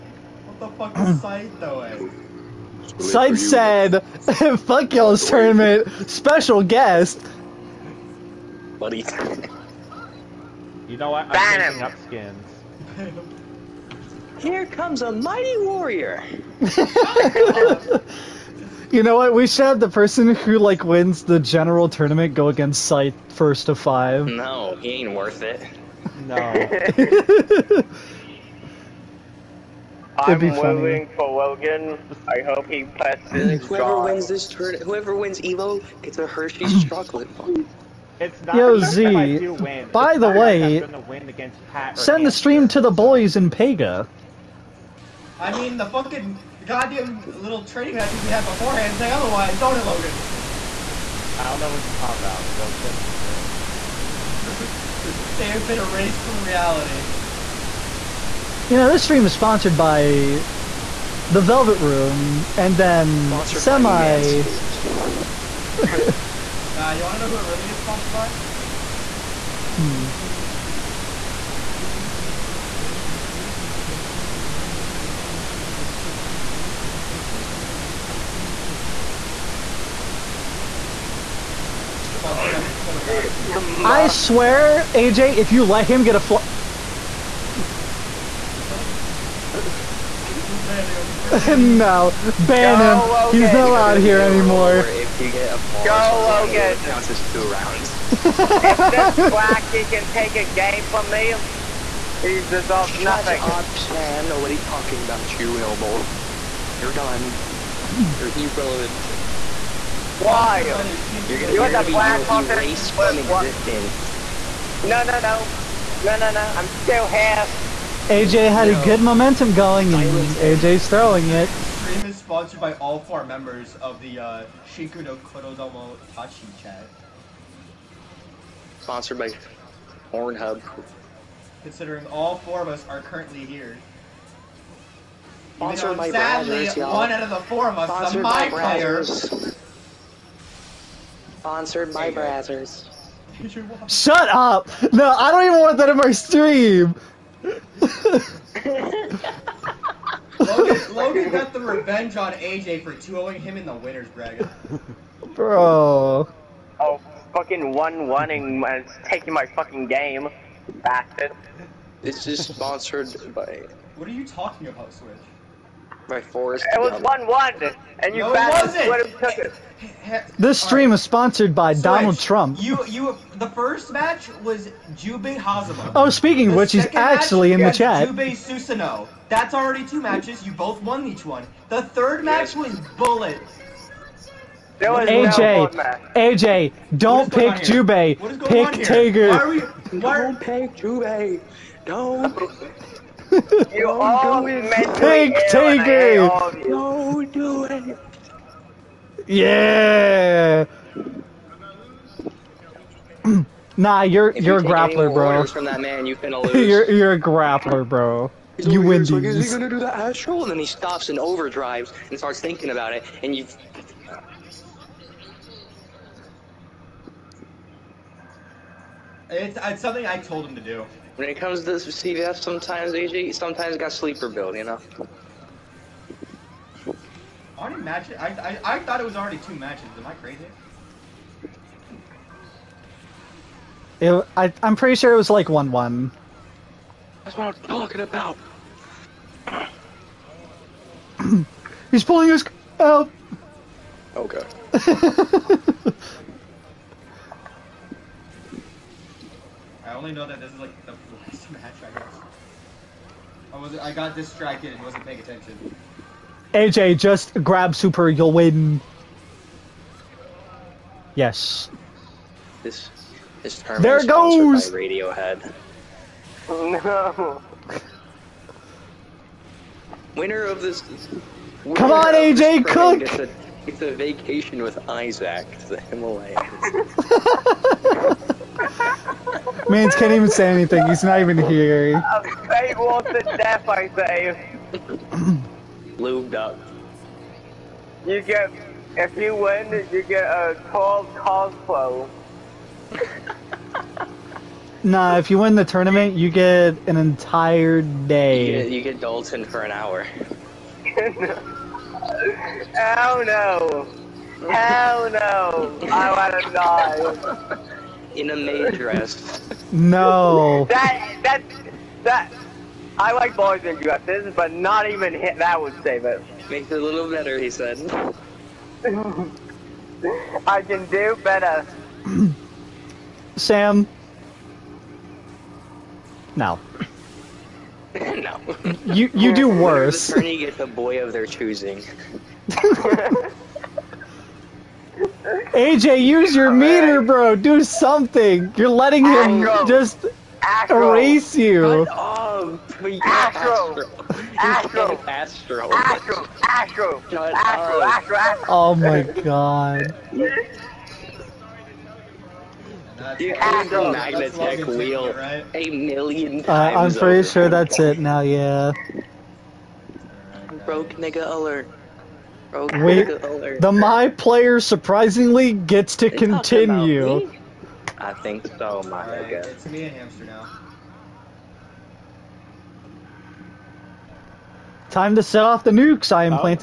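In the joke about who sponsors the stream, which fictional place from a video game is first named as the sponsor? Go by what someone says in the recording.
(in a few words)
The Velvet Room.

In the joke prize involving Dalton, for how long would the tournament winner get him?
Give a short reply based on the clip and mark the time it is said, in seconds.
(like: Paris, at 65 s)
an hour, at 299 s.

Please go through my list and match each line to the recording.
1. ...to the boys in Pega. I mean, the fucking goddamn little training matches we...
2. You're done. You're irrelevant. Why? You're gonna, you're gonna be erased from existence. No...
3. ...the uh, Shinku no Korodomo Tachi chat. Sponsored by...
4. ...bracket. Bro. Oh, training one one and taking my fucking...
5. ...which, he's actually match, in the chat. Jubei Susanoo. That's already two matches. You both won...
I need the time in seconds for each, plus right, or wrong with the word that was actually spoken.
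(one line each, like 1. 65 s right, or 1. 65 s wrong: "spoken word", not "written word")
1. 42 s right
2. 106 s right
3. 124 s right
4. 154 s wrong: "fucking", not "training"
5. 176 s right.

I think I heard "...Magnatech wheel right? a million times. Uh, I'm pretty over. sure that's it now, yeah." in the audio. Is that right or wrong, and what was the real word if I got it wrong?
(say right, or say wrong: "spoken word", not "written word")
right.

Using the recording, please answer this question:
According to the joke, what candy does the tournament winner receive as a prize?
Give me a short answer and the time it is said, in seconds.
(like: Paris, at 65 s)
Hershey's chocolate bar, at 36 s.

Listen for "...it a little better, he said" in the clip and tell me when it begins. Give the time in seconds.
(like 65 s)
316 s.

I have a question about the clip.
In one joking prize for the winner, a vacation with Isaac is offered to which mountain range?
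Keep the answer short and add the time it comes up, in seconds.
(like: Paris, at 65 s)
Himalayas, at 275 s.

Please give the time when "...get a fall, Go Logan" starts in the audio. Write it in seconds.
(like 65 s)
95 s.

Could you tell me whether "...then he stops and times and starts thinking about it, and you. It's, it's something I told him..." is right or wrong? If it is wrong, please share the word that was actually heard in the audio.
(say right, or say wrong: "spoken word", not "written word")
wrong: "overdrives", not "times".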